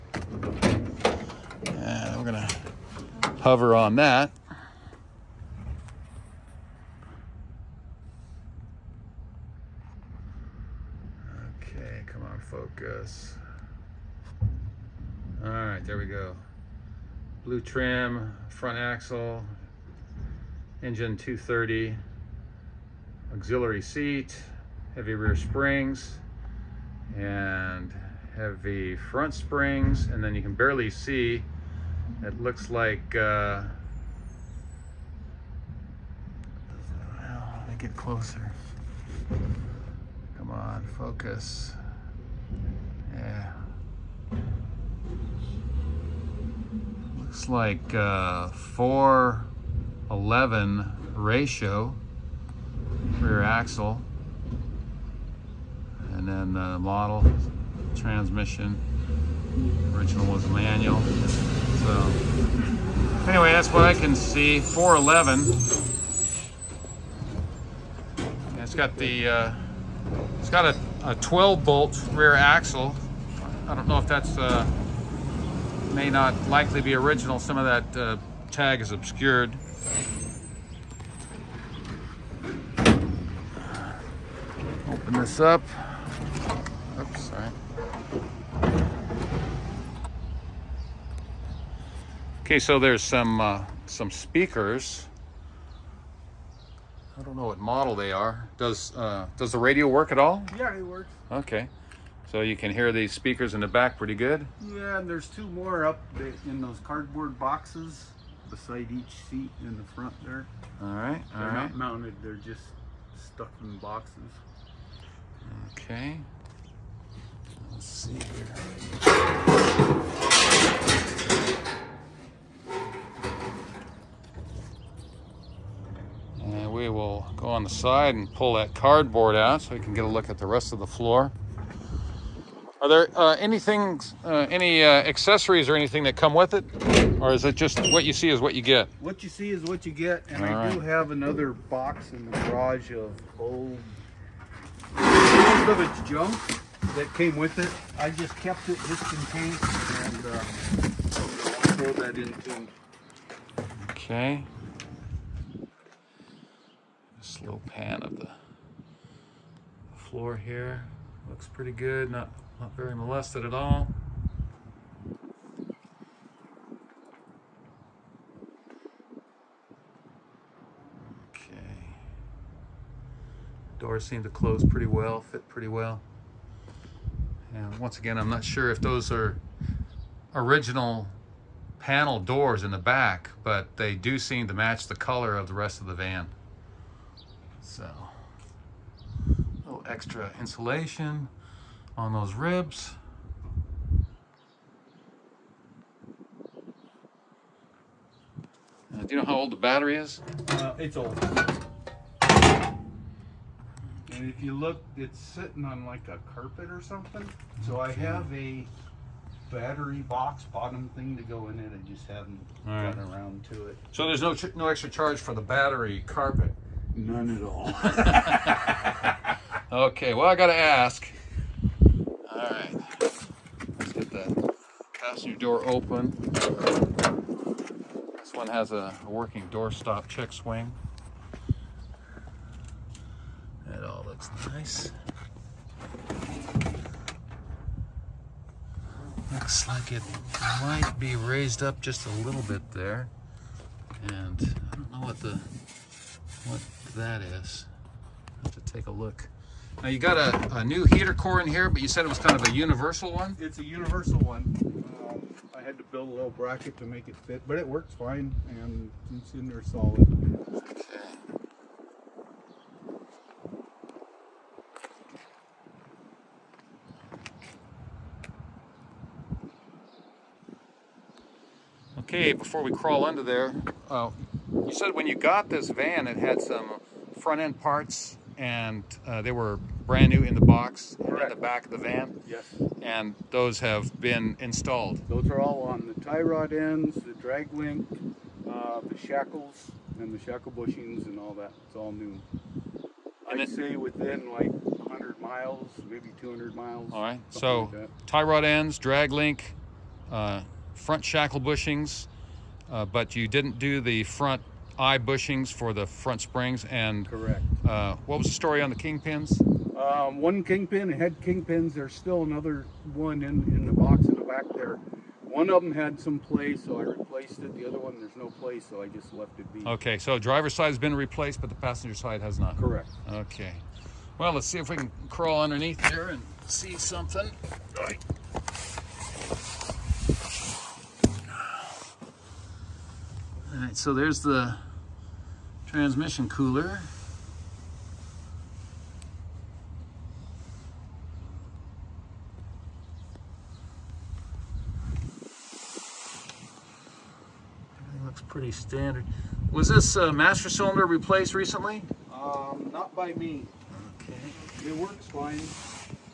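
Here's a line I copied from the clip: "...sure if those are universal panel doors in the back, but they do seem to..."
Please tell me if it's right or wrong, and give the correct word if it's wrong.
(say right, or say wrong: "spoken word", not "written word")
wrong: "original", not "universal".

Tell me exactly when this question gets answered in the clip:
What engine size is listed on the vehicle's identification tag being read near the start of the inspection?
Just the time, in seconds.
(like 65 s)
20 s.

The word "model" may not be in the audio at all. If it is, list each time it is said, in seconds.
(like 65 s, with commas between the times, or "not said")
56 s, 97 s.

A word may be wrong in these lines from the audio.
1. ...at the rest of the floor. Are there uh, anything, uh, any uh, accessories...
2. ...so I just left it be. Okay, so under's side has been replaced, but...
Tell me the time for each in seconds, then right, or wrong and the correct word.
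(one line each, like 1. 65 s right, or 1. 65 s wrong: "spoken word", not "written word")
1. 130 s right
2. 318 s wrong: "driver", not "under".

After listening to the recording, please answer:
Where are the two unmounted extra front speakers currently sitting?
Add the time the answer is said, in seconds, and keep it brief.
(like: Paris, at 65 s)
cardboard boxes, at 106 s.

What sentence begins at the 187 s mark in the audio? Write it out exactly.
So, a little extra insulation on those ribs.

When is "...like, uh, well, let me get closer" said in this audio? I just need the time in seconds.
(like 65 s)
32 s.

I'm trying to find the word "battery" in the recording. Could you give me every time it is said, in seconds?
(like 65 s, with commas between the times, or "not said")
199 s, 209 s, 215 s.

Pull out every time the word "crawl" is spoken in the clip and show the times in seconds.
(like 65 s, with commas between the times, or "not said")
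272 s, 325 s.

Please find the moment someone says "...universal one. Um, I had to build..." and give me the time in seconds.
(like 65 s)
253 s.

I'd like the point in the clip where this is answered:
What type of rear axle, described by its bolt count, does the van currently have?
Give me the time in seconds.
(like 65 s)
71 s.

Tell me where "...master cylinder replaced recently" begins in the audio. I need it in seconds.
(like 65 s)
350 s.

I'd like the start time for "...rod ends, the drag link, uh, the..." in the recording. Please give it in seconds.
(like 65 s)
286 s.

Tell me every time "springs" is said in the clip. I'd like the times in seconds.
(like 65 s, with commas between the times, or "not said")
25 s, 29 s, 306 s.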